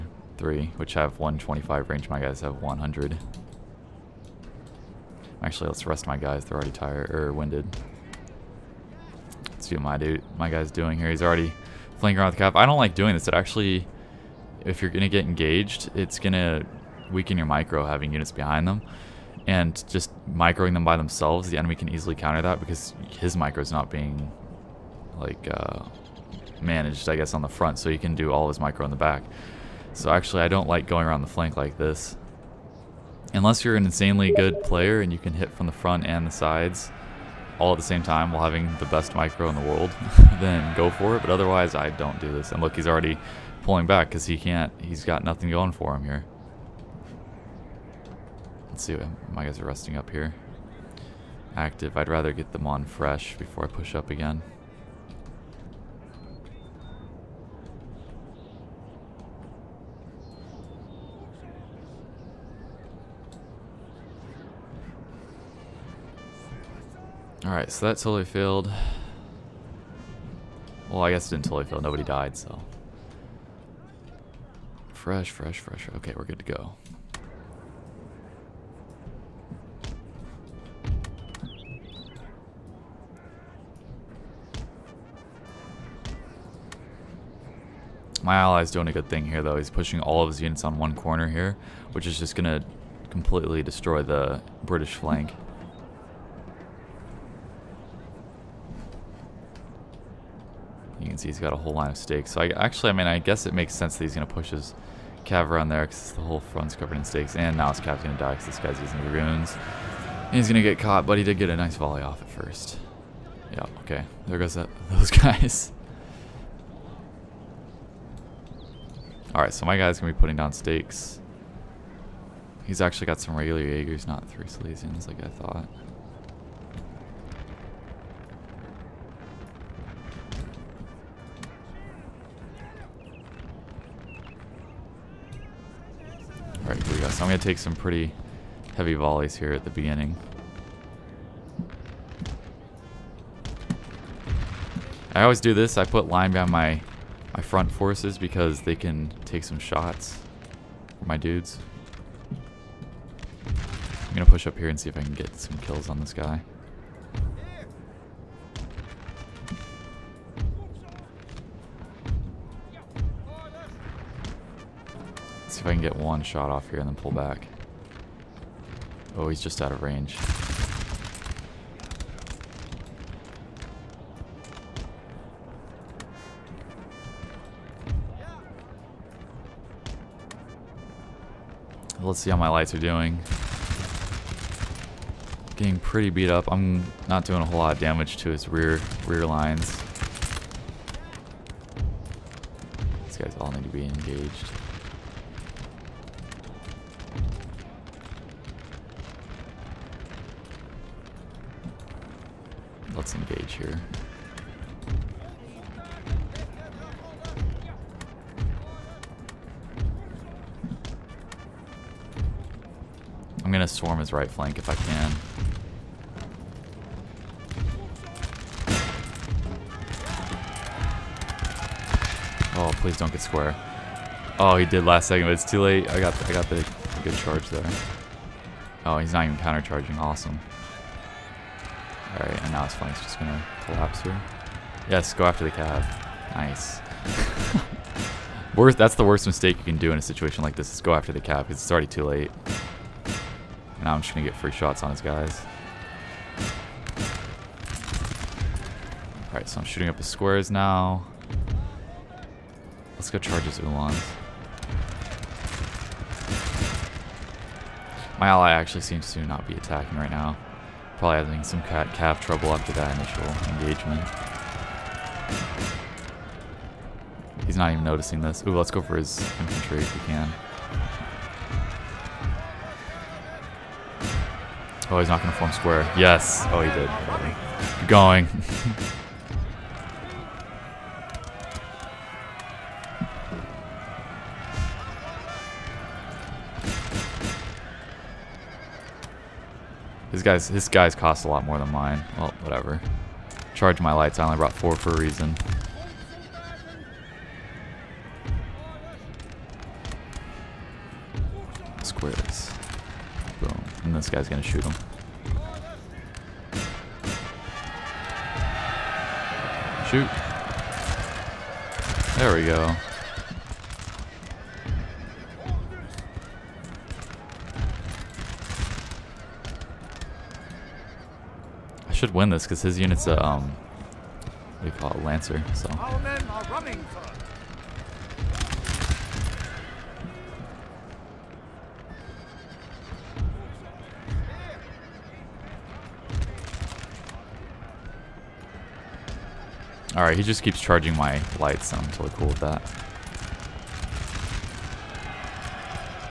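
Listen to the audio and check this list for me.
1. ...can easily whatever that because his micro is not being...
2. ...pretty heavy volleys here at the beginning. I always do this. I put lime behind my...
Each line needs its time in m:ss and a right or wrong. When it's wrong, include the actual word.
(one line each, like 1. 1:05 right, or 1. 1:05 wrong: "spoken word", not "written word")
1. 0:21 wrong: "counter", not "whatever"
2. 2:17 right.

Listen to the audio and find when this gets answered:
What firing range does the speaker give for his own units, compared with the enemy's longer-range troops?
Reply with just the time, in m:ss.
0:02.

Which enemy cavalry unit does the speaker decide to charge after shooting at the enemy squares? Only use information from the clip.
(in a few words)
Ulans.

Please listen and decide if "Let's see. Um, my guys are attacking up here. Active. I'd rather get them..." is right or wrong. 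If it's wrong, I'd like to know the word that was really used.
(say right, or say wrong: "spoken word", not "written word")
wrong: "resting", not "attacking".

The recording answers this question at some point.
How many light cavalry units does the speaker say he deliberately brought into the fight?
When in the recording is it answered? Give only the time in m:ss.
4:54.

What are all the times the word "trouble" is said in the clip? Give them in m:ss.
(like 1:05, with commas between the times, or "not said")
4:22.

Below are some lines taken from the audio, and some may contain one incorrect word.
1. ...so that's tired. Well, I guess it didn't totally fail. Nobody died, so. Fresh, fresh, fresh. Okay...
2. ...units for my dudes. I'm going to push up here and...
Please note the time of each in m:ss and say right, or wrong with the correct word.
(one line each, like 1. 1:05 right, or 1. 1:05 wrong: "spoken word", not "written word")
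1. 1:07 wrong: "failed", not "tired"
2. 2:29 wrong: "shots", not "units".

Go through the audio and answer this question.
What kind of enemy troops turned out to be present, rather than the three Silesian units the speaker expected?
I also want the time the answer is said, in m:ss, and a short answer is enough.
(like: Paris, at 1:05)
regular Jaegers, at 2:03.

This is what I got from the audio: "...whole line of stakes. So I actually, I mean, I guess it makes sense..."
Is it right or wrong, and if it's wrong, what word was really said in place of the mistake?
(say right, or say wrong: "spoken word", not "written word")
right.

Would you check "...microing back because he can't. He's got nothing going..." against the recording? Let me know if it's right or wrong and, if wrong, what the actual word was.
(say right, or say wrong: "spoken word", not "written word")
wrong: "pulling", not "microing".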